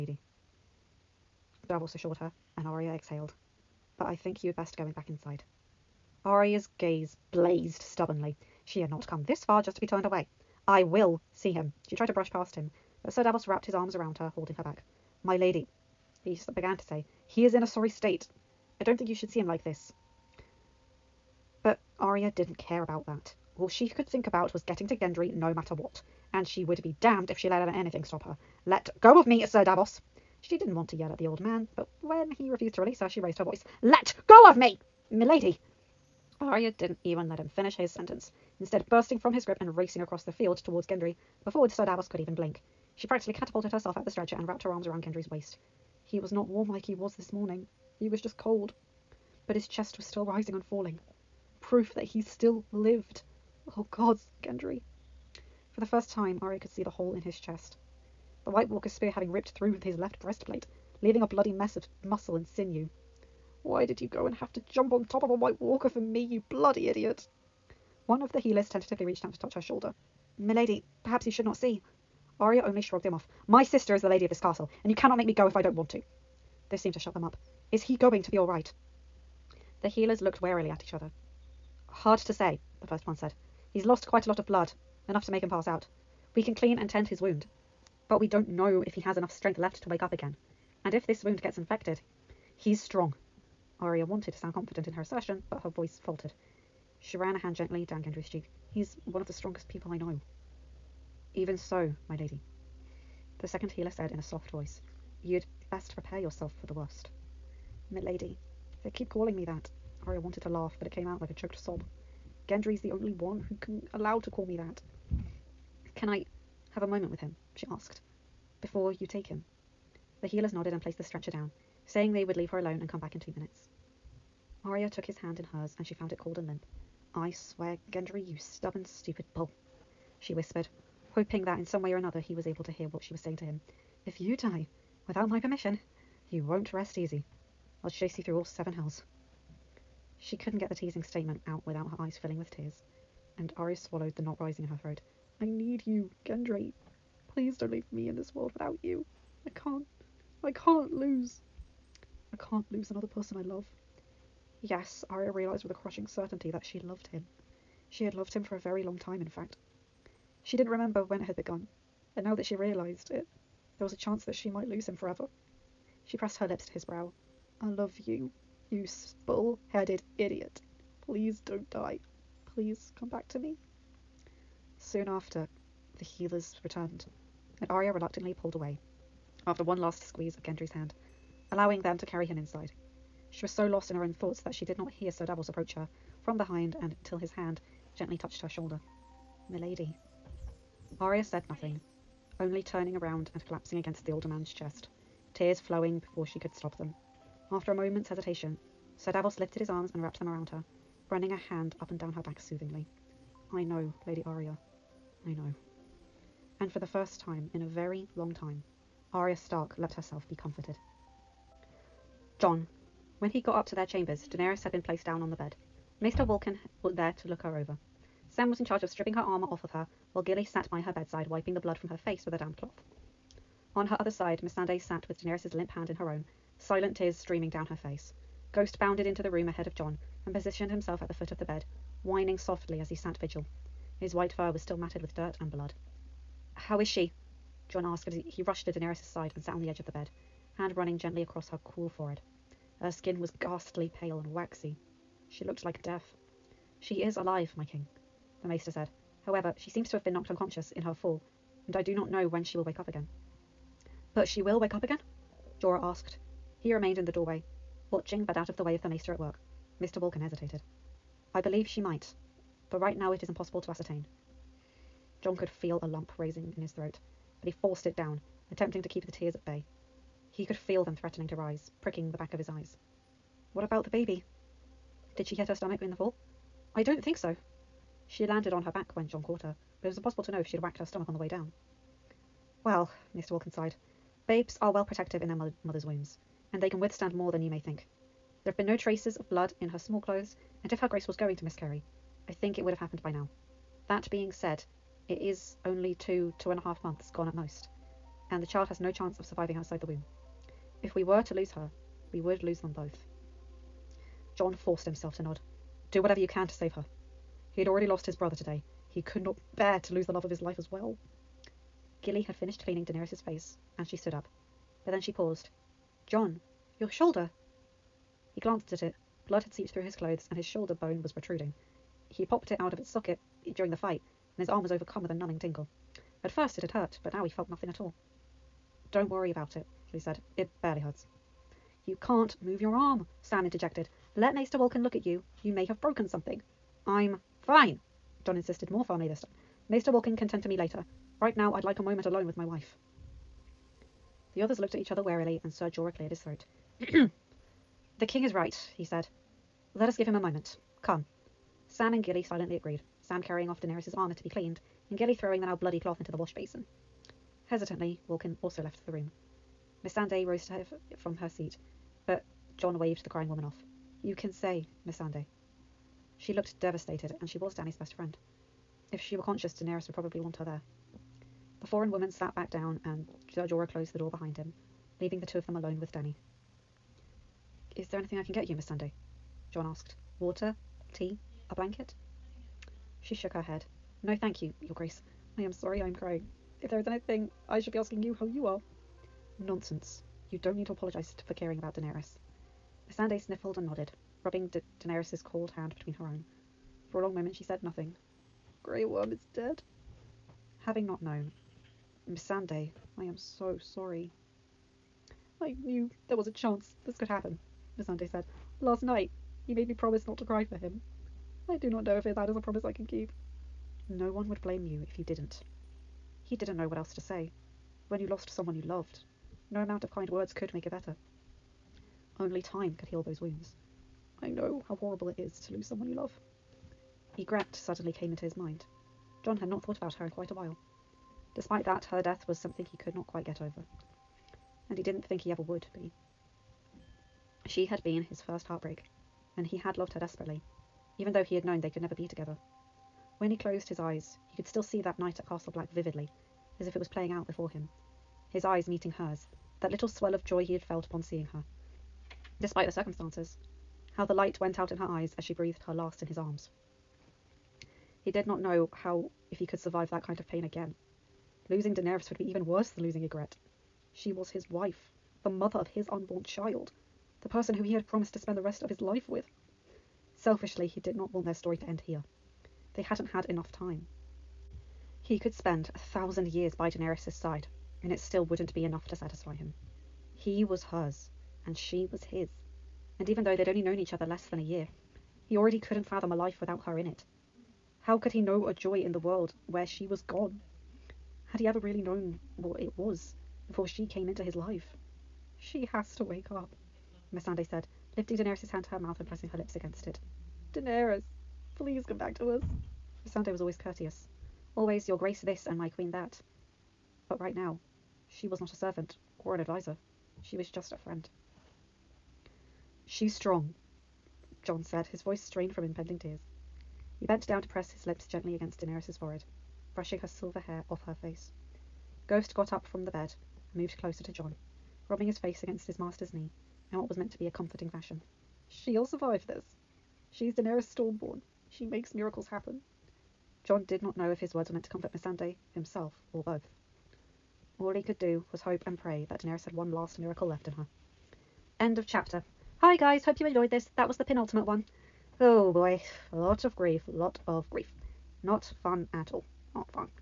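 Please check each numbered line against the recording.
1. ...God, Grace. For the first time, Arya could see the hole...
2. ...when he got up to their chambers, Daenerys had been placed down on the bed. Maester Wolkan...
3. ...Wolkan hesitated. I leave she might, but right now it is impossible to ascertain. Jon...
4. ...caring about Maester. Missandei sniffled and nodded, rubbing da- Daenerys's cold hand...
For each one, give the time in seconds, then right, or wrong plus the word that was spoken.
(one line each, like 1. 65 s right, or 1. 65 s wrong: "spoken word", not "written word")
1. 53 s wrong: "Gendry", not "Grace"
2. 213 s right
3. 259 s wrong: "believe", not "leave"
4. 391 s wrong: "Daenerys", not "Maester".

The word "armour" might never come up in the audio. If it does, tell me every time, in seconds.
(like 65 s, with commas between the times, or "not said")
219 s, 353 s.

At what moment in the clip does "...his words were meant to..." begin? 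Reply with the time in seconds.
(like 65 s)
534 s.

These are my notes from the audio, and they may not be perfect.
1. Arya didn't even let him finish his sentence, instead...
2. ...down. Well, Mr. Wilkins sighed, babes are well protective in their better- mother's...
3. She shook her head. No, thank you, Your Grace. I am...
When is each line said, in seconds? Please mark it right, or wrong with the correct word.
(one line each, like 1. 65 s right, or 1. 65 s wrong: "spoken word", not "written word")
1. 36 s right
2. 281 s wrong: "mother", not "better"
3. 383 s right.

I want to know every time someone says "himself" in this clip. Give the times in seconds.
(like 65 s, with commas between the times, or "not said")
230 s, 304 s, 535 s.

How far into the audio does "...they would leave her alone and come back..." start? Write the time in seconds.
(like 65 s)
122 s.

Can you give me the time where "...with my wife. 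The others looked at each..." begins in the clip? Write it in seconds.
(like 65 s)
342 s.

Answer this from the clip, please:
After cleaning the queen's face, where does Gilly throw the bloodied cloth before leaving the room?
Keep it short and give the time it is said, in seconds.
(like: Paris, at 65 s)
the wash basin, at 356 s.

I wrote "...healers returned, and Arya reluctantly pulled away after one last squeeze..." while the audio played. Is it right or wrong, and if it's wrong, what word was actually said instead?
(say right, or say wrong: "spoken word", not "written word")
right.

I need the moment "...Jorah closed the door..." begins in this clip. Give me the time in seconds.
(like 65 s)
373 s.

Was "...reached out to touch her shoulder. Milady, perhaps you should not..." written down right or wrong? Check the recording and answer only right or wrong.
right.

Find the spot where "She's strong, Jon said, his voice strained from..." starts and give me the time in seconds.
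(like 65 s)
512 s.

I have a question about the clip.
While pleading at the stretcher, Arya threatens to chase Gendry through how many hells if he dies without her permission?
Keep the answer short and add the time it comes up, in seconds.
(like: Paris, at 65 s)
7, at 138 s.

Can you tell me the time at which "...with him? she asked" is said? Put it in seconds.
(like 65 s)
117 s.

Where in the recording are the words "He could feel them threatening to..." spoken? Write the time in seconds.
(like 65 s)
270 s.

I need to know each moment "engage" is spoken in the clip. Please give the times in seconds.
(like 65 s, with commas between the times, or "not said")
not said.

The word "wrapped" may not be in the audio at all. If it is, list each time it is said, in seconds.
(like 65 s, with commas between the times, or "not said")
13 s, 44 s, 200 s.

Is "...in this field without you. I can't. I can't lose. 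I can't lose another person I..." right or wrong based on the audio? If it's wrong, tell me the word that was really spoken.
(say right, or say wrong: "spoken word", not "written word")
wrong: "world", not "field".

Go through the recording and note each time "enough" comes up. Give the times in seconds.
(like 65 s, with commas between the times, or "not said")
85 s, 89 s, 473 s, 478 s.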